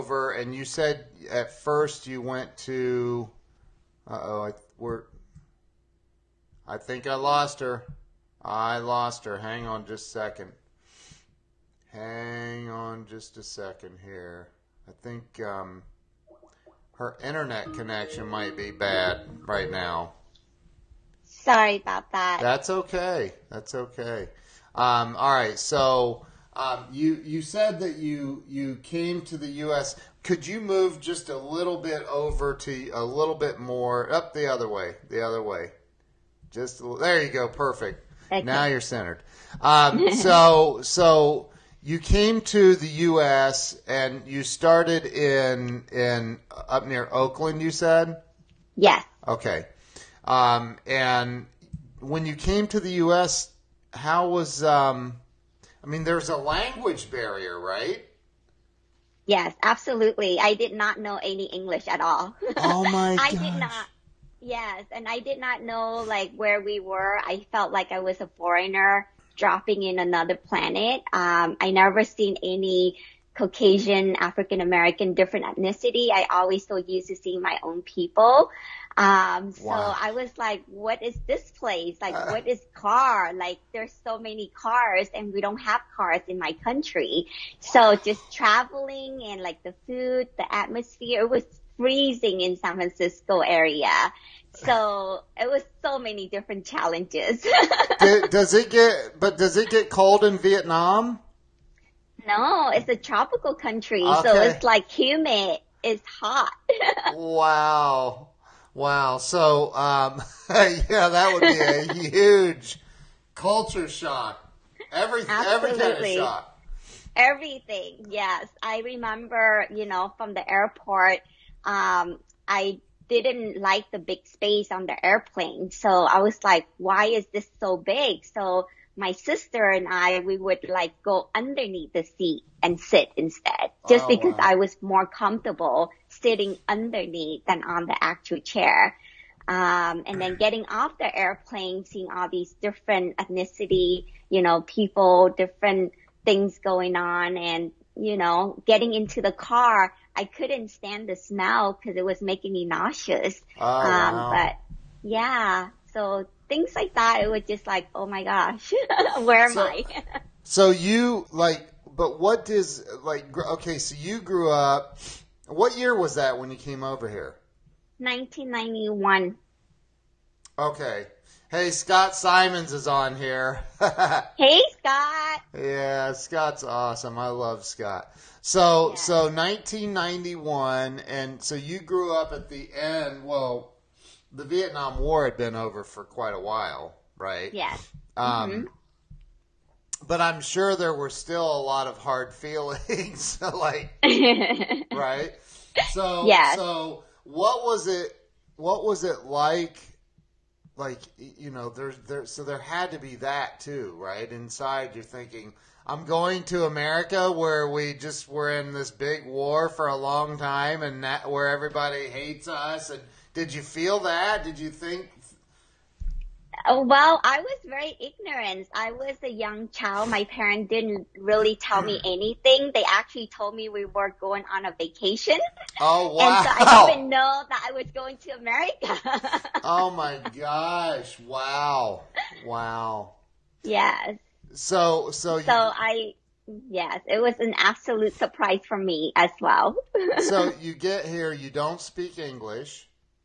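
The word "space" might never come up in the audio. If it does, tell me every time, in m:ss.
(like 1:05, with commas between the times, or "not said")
2:04.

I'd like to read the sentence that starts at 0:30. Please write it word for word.
Could you move just a little bit over to a little bit more up the other way?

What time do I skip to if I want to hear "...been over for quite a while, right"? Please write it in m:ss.
3:05.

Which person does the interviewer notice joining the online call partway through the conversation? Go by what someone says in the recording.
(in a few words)
Scott Simons.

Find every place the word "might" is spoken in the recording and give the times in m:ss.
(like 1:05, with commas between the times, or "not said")
0:18.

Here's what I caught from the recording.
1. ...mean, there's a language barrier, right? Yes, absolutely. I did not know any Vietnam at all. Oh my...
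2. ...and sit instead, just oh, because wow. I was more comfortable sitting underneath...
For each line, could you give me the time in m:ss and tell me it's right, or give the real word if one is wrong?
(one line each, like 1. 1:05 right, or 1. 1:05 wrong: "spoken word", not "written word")
1. 0:55 wrong: "English", not "Vietnam"
2. 2:12 right.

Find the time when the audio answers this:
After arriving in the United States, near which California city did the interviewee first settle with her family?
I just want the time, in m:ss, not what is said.
0:47.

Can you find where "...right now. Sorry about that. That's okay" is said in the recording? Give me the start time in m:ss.
0:19.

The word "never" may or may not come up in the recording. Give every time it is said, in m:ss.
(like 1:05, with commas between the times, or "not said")
1:11.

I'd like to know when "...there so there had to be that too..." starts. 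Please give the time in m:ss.
3:22.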